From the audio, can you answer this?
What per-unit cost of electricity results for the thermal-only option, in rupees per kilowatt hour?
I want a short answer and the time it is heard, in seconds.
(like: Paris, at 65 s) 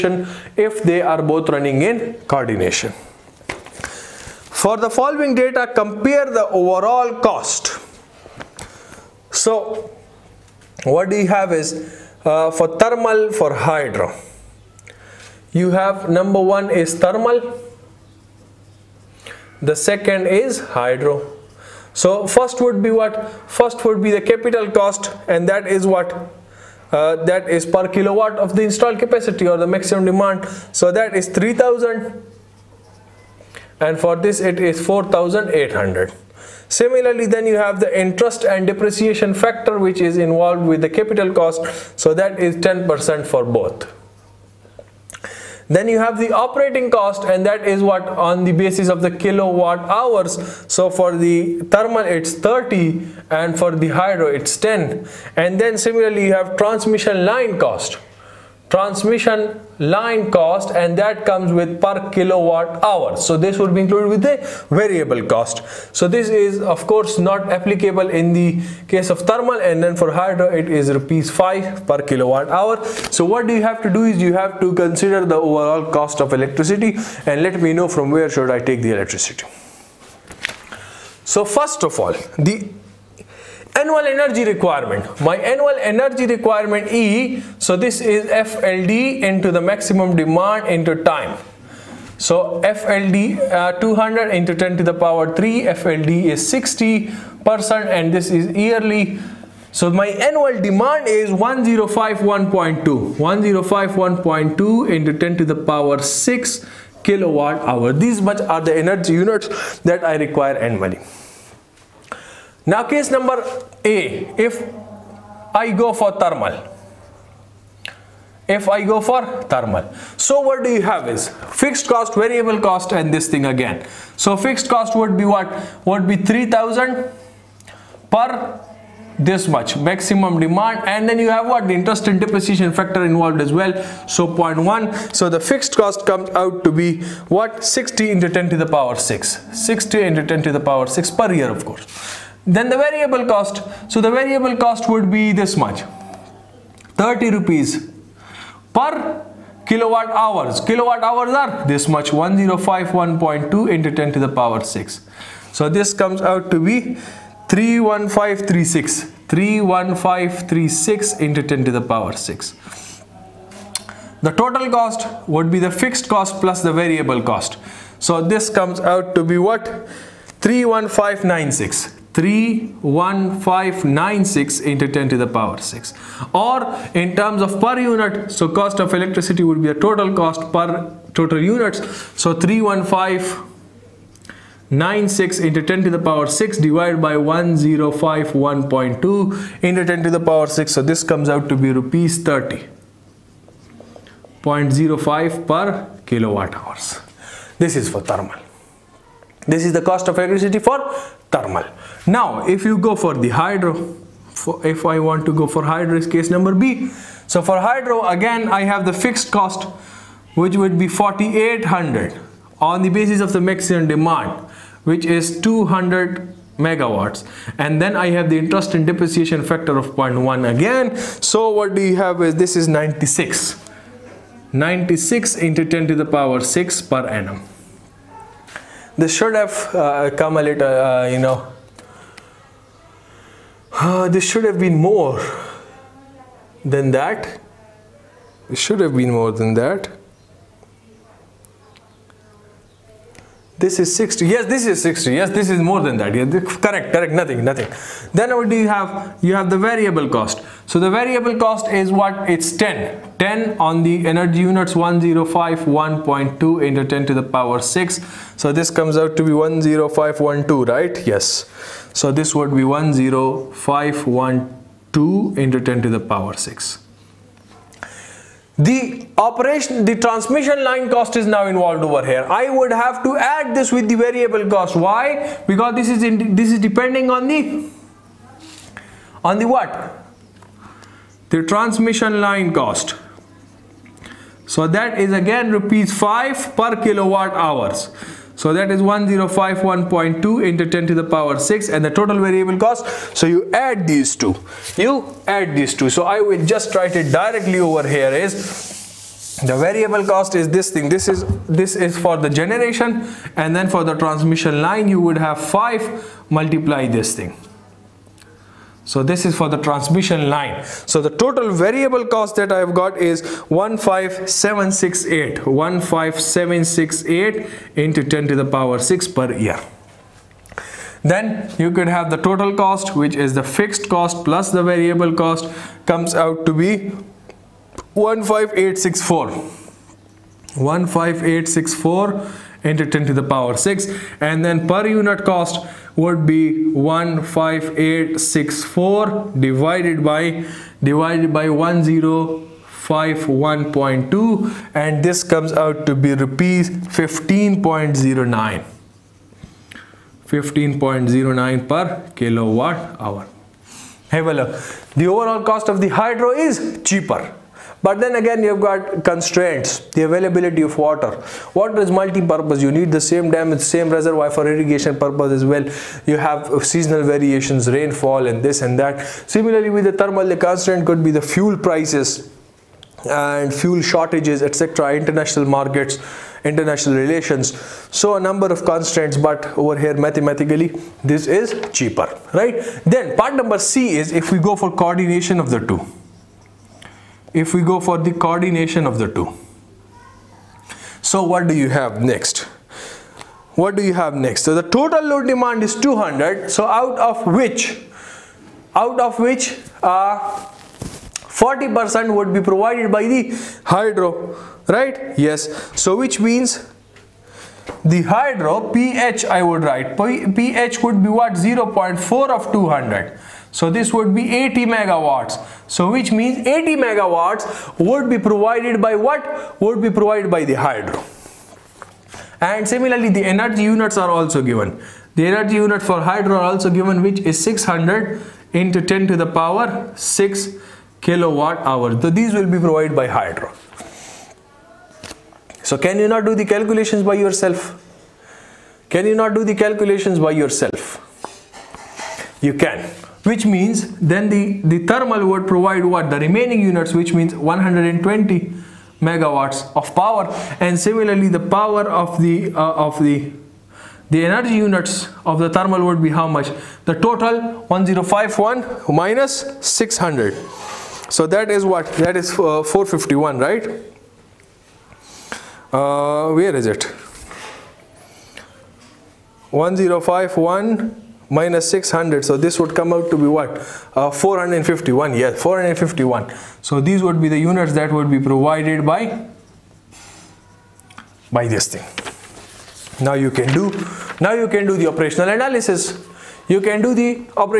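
30.05, at 191 s.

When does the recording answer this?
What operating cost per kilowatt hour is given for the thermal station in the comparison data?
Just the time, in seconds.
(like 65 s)
50 s.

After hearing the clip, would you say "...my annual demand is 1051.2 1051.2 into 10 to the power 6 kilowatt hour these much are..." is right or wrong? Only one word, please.
right.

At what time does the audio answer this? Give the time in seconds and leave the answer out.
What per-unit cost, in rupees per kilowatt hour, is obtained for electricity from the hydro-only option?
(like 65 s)
346 s.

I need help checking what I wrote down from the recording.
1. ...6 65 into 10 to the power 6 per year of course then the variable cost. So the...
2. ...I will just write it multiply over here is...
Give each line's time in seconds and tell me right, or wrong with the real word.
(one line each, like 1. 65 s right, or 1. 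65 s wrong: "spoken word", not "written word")
1. 138 s wrong: "60", not "65"
2. 296 s wrong: "directly", not "multiply".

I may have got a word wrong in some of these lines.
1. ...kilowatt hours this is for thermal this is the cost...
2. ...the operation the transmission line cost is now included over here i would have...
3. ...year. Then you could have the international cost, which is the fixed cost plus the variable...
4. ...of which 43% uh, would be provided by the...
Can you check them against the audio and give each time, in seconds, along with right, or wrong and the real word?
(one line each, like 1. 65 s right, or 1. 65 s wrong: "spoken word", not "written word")
1. 196 s right
2. 268 s wrong: "involved", not "included"
3. 319 s wrong: "total", not "international"
4. 398 s wrong: "40", not "43".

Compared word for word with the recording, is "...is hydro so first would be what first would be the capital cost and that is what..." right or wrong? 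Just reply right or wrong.
right.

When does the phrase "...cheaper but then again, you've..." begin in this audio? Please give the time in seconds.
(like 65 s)
356 s.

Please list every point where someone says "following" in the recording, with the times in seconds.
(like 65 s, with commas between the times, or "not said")
4 s.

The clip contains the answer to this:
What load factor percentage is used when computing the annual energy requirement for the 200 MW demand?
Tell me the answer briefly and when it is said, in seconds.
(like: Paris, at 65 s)
60 percent, at 95 s.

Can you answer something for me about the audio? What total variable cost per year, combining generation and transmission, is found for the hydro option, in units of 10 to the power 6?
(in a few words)
15768.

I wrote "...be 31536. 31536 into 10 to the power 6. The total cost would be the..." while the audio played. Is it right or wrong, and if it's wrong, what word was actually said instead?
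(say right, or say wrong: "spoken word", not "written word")
right.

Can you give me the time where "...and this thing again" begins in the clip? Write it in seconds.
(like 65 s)
122 s.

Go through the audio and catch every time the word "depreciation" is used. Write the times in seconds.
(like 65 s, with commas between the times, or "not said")
38 s, 132 s, 218 s.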